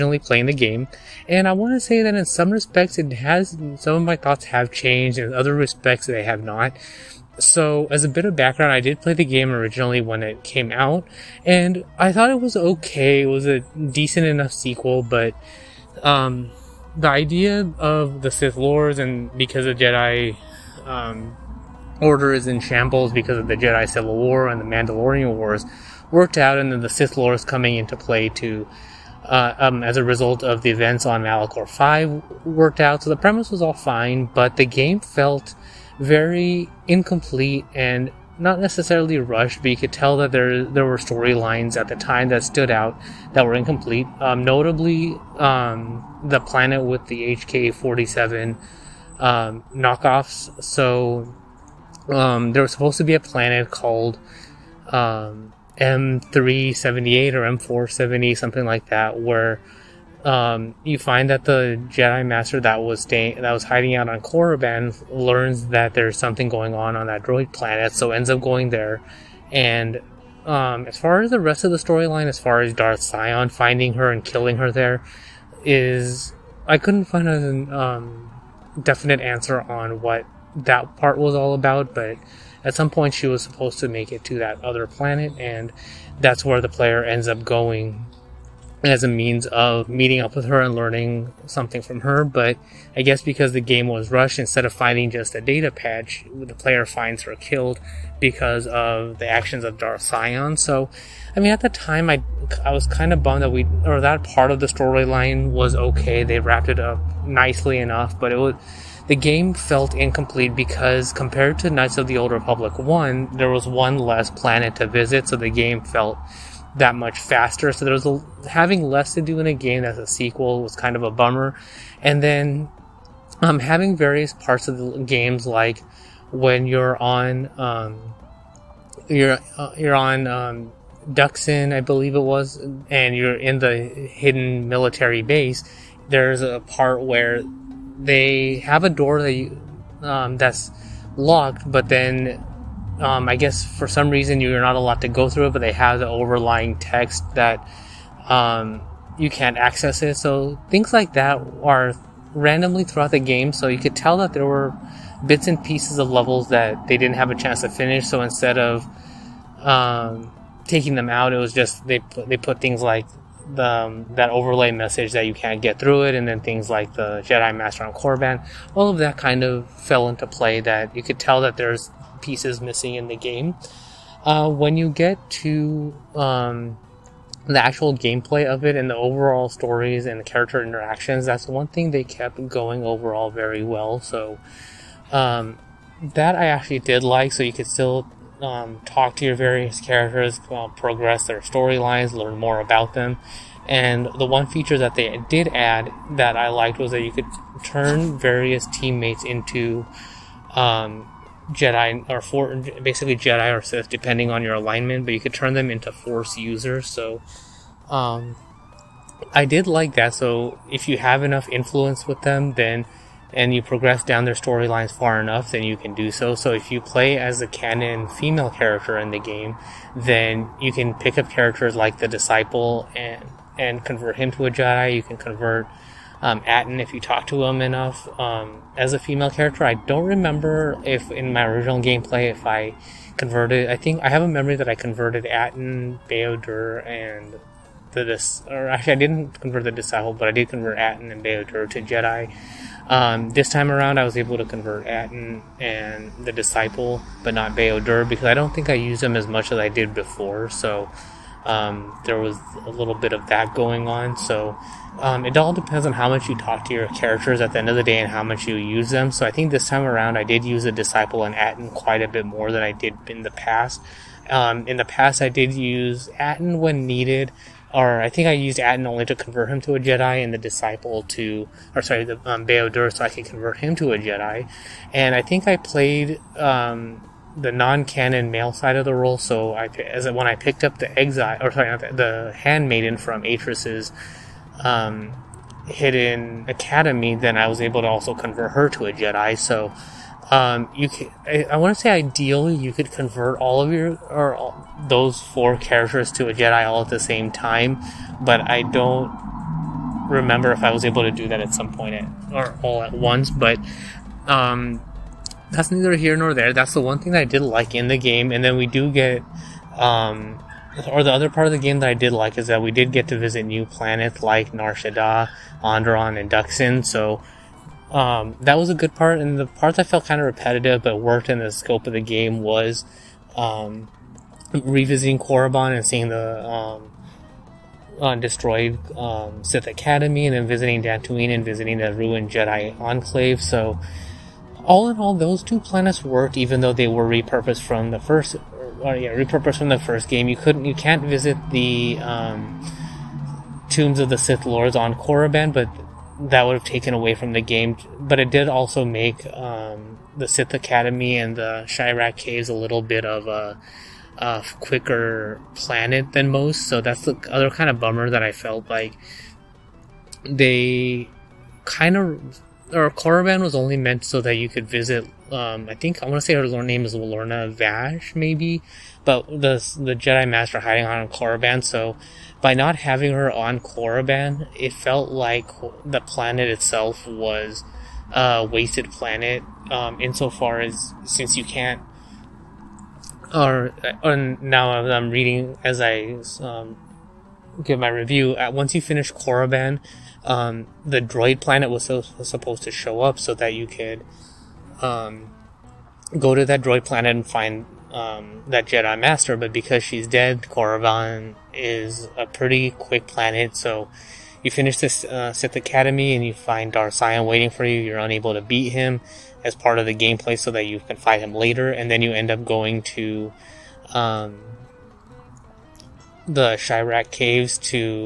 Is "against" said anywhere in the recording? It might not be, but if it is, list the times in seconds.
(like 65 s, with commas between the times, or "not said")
not said.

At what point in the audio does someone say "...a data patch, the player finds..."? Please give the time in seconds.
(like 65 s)
95 s.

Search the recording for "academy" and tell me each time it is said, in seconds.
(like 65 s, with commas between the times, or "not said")
286 s, 329 s, 350 s, 405 s.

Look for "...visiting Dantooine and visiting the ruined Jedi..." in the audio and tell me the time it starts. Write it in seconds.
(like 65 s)
330 s.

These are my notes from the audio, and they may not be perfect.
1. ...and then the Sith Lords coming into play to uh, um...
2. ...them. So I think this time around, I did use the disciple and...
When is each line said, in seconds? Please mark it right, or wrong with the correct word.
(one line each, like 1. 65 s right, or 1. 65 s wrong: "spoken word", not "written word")
1. 26 s right
2. 258 s right.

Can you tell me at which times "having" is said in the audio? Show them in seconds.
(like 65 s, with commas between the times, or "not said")
118 s, 123 s, 372 s.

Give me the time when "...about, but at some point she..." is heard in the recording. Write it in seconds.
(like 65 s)
81 s.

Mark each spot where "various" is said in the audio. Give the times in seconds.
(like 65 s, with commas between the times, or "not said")
123 s, 189 s, 198 s.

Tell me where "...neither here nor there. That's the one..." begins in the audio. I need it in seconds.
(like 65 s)
305 s.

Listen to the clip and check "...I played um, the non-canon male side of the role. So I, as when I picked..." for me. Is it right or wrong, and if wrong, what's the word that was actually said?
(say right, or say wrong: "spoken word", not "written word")
right.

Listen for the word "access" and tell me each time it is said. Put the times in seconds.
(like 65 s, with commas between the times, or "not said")
149 s.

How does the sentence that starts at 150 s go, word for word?
So things like that are randomly throughout the game.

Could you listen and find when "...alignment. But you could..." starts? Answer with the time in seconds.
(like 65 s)
204 s.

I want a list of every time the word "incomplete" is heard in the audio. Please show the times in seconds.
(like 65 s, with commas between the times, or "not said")
36 s, 43 s, 109 s.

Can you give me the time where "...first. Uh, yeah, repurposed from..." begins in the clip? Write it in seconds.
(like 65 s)
337 s.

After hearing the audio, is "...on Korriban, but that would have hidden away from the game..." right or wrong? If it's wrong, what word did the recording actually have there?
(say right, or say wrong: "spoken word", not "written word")
wrong: "taken", not "hidden".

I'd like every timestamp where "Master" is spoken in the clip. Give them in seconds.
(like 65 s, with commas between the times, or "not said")
62 s, 167 s, 370 s, 398 s.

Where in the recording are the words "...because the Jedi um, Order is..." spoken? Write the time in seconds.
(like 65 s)
19 s.